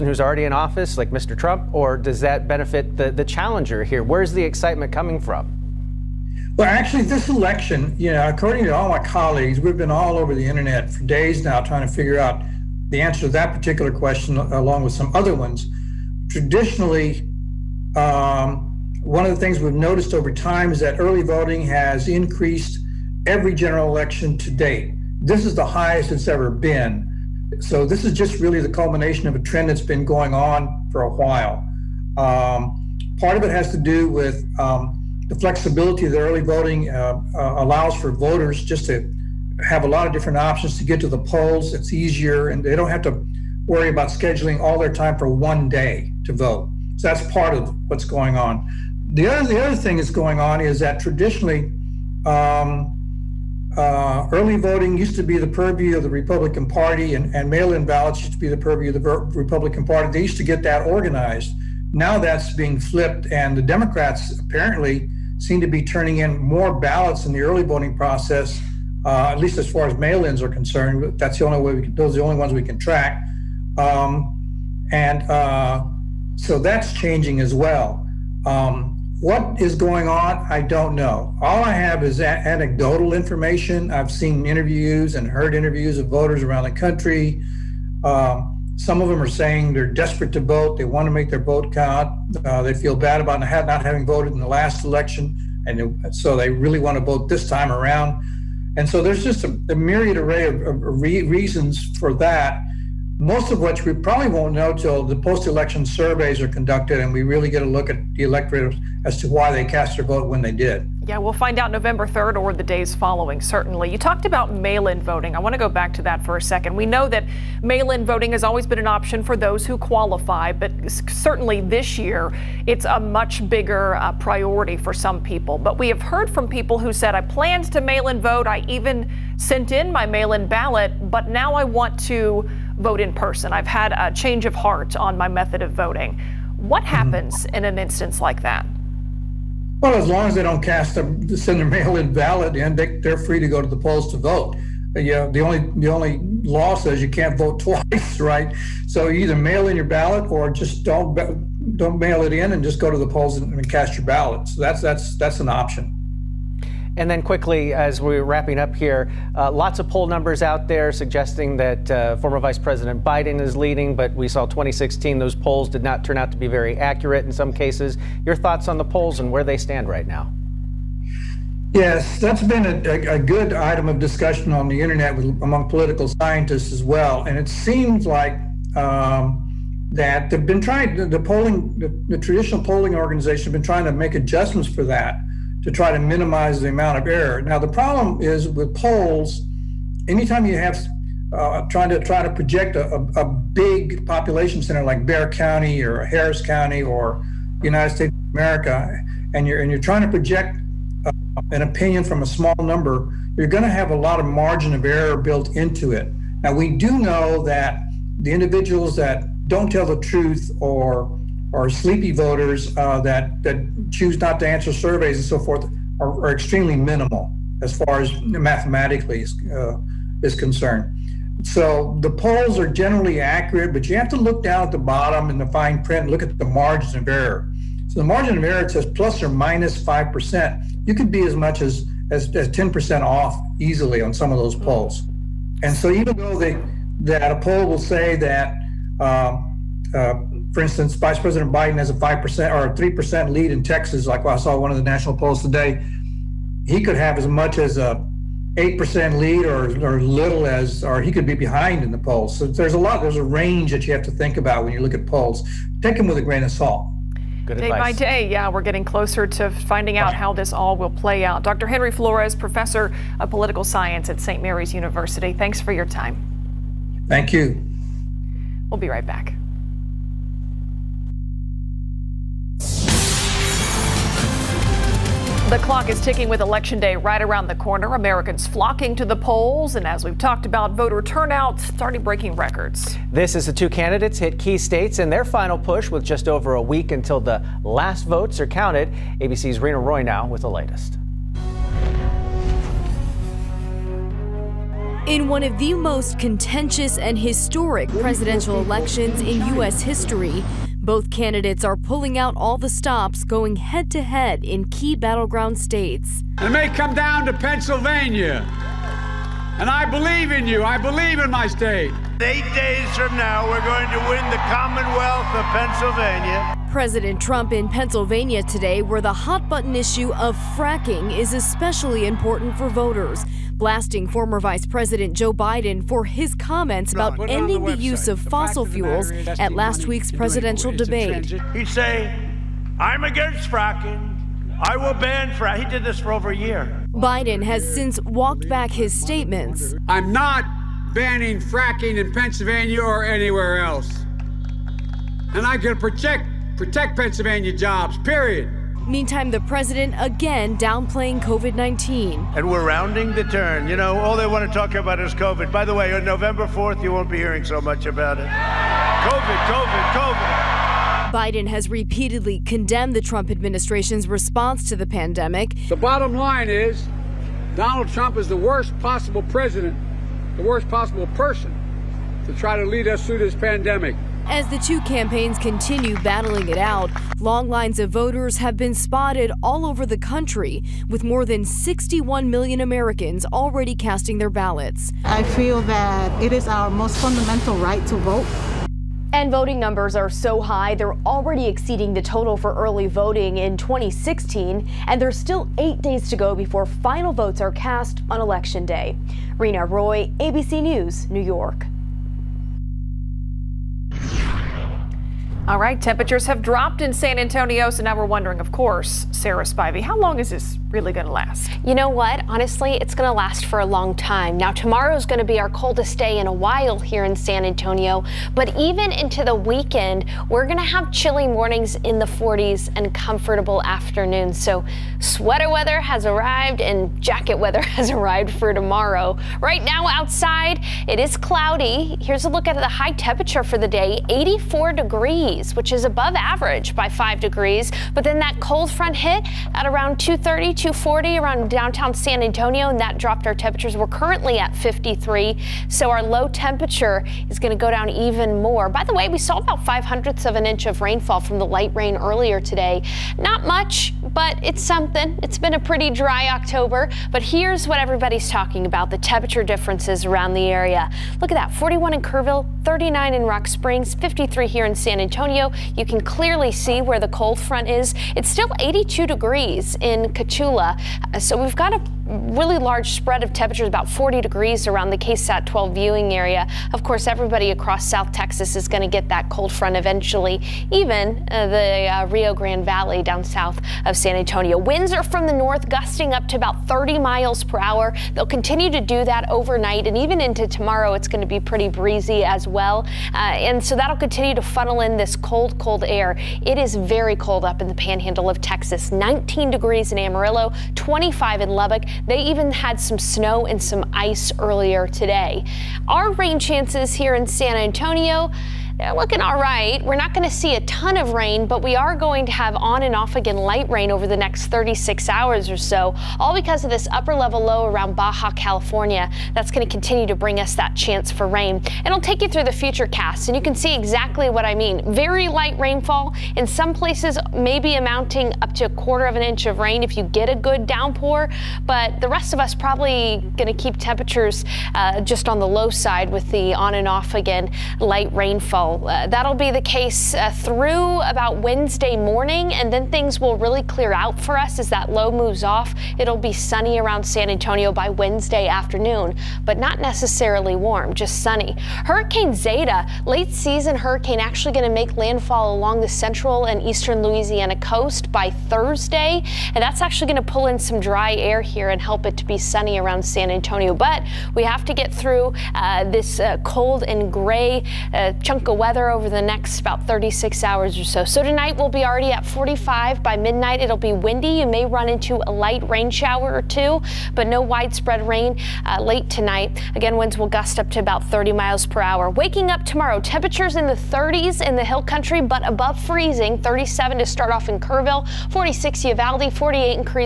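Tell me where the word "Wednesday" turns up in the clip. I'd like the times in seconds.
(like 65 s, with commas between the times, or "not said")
541 s, 547 s.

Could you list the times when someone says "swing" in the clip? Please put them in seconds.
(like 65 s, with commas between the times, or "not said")
not said.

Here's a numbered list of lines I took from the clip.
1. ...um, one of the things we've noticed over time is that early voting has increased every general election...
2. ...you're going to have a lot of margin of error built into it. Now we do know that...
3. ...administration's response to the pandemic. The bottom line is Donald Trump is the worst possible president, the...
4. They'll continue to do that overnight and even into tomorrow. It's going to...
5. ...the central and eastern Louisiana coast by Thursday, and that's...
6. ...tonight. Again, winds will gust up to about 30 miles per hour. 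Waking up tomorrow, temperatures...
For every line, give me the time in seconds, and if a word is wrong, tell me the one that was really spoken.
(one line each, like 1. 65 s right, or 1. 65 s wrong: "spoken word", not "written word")
1. 17 s right
2. 203 s right
3. 363 s right
4. 488 s right
5. 555 s right
6. 579 s right.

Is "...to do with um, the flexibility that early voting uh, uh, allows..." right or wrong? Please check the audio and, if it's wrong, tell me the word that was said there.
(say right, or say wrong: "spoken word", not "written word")
right.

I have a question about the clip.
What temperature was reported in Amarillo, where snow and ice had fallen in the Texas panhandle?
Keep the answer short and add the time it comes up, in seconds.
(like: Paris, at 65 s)
19 degrees, at 498 s.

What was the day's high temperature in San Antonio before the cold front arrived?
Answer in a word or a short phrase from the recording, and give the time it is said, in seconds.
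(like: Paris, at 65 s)
84 degrees, at 434 s.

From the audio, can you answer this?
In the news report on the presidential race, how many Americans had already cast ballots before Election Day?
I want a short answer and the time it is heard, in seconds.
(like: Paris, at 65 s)
more than 61 million, at 381 s.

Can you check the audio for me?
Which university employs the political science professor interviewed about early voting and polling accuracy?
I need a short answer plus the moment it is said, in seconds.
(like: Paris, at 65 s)
St. Mary's University, at 264 s.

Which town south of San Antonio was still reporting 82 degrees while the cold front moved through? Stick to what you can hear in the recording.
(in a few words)
Cotulla.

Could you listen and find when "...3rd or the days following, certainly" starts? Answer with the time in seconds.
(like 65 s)
112 s.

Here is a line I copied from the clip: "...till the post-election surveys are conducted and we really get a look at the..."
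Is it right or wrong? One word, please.
right.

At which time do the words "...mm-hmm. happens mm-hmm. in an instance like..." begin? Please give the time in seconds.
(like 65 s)
136 s.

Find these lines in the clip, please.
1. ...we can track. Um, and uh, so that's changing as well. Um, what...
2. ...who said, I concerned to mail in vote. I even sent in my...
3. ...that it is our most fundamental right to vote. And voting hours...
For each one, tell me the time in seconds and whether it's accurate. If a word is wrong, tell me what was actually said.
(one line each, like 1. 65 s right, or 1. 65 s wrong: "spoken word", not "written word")
1. 72 s right
2. 126 s wrong: "planned", not "concerned"
3. 385 s wrong: "numbers", not "hours".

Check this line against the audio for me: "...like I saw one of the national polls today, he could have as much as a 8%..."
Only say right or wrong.
right.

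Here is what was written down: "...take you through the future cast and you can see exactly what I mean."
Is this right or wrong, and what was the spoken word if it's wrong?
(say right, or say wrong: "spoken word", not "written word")
right.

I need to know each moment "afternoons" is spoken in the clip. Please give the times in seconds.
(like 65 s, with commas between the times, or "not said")
423 s, 548 s.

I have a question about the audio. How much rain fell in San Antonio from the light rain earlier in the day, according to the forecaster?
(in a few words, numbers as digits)
5 hundredths of an inch.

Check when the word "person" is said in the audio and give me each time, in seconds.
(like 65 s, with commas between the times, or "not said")
133 s, 371 s.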